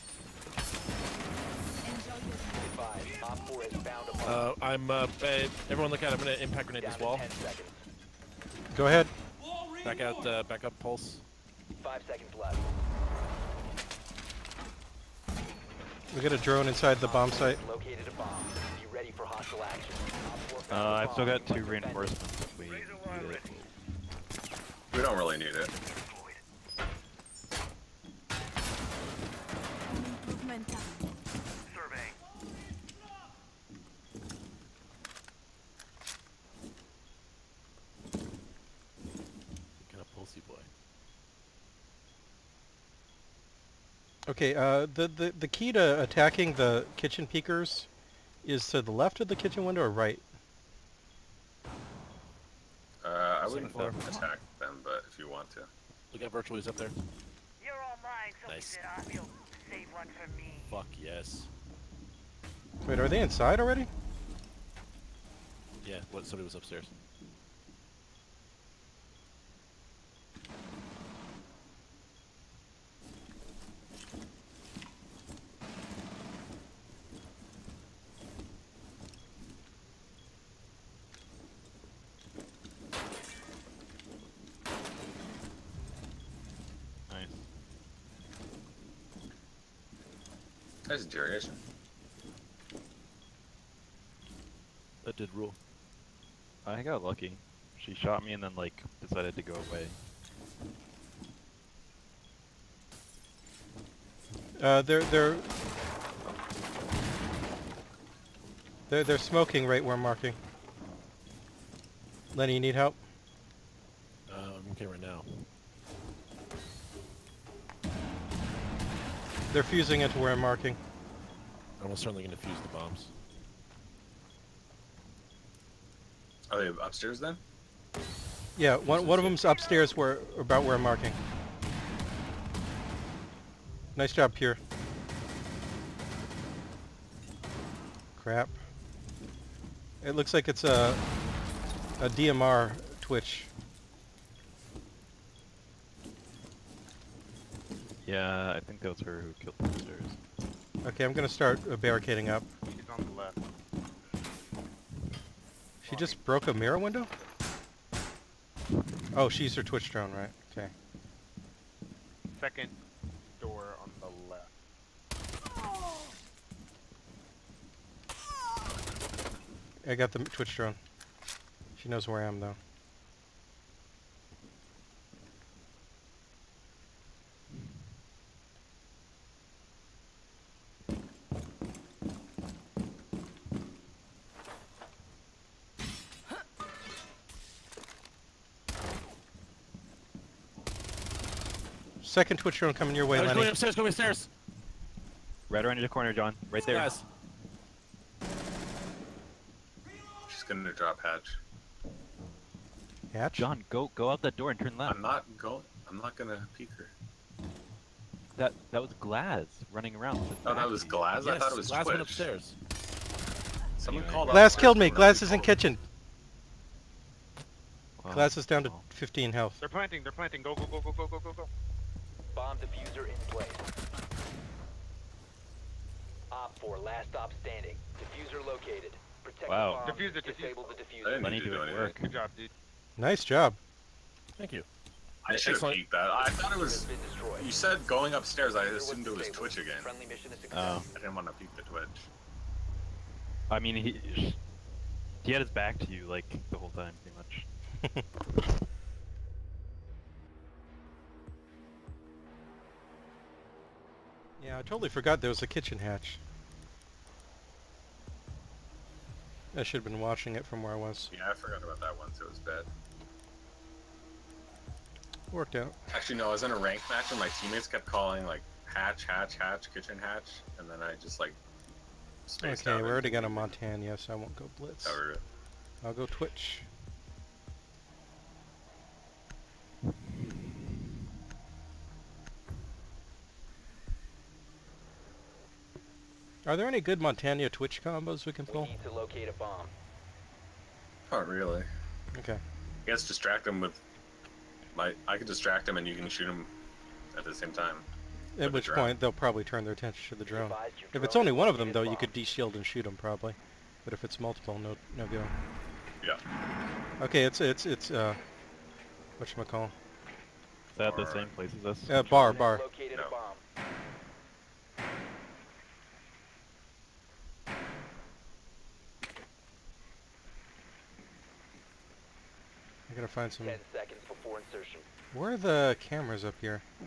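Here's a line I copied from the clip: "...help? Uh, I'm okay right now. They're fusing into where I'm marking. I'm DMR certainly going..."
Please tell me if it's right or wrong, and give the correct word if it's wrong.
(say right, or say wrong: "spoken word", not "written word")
wrong: "Almost", not "DMR".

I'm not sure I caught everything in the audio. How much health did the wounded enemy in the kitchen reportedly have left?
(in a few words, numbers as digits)
15.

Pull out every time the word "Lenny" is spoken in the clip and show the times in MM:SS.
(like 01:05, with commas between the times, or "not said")
01:52, 03:13.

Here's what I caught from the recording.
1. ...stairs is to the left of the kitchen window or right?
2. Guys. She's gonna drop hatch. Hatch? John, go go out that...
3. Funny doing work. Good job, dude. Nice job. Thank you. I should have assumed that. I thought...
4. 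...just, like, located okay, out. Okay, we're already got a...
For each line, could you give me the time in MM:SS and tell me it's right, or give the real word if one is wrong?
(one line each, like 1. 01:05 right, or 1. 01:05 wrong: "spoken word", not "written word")
1. 00:47 wrong: "peekers", not "stairs"
2. 03:16 right
3. 03:51 wrong: "peeked", not "assumed"
4. 04:30 wrong: "spaced", not "located".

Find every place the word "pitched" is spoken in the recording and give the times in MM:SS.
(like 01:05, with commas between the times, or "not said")
not said.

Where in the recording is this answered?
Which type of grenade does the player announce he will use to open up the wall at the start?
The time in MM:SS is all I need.
00:06.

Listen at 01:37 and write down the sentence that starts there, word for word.
She shot me and then like decided to go away.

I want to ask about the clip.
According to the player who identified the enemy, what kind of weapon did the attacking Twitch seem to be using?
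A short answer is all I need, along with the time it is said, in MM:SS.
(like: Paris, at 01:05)
DMR, at 02:22.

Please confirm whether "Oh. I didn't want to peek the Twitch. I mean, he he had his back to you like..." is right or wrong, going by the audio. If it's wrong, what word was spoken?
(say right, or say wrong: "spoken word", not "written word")
right.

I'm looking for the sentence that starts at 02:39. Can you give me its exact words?
Oh, she's her twitch drone, right?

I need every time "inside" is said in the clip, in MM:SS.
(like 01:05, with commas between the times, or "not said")
00:16, 01:03.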